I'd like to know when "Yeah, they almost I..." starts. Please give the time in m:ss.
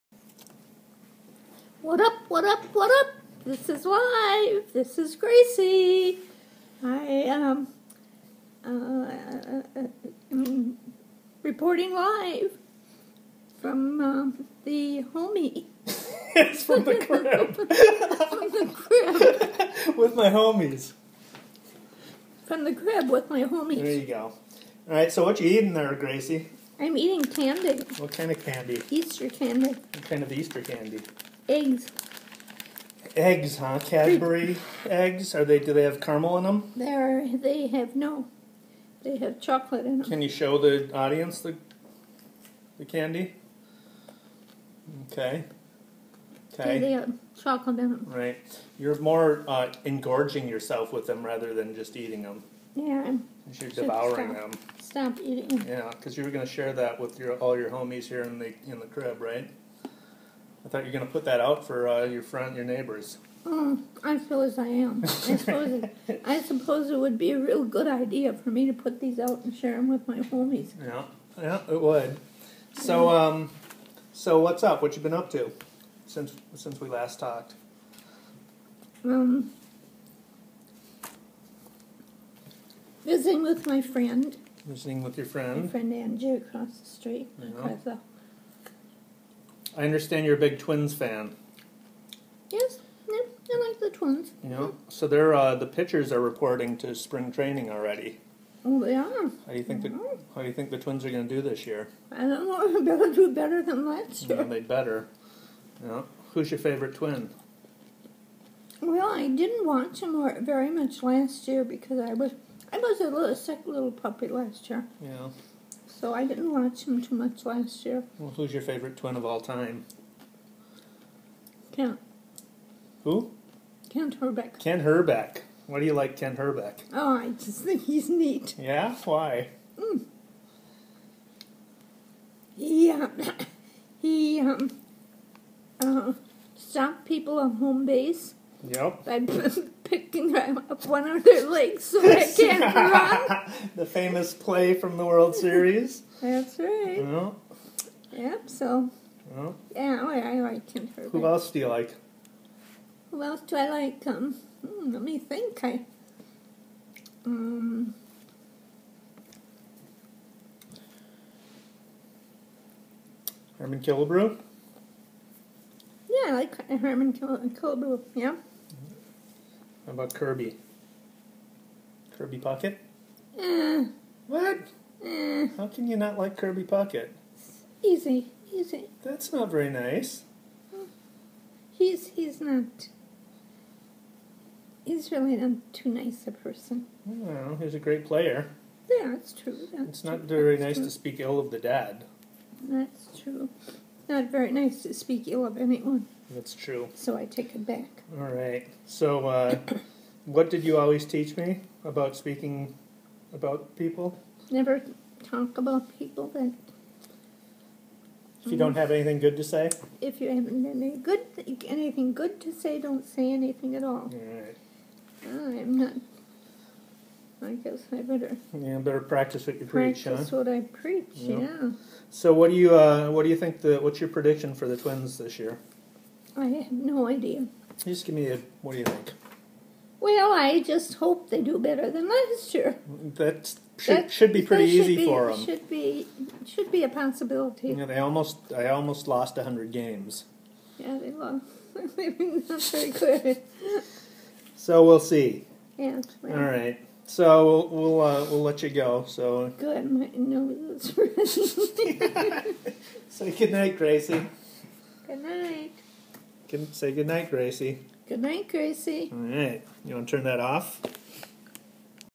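3:57.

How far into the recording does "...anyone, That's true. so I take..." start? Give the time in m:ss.
3:15.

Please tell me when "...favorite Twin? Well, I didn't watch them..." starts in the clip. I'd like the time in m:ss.
1:46.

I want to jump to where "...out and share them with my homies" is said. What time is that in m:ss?
1:09.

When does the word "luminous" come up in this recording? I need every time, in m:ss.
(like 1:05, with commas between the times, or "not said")
not said.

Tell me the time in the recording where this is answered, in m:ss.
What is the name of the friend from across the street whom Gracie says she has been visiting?
1:25.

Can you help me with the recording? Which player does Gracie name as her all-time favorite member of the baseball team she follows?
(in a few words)
Kent Hrbek.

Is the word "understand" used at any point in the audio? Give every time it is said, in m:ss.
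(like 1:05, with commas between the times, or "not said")
1:29.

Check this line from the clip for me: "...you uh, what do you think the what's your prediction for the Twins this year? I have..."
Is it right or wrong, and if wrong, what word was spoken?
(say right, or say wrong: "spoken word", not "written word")
right.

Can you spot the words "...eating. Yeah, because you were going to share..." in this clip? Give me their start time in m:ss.
0:55.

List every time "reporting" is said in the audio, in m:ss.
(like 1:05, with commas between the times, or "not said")
0:11, 1:36.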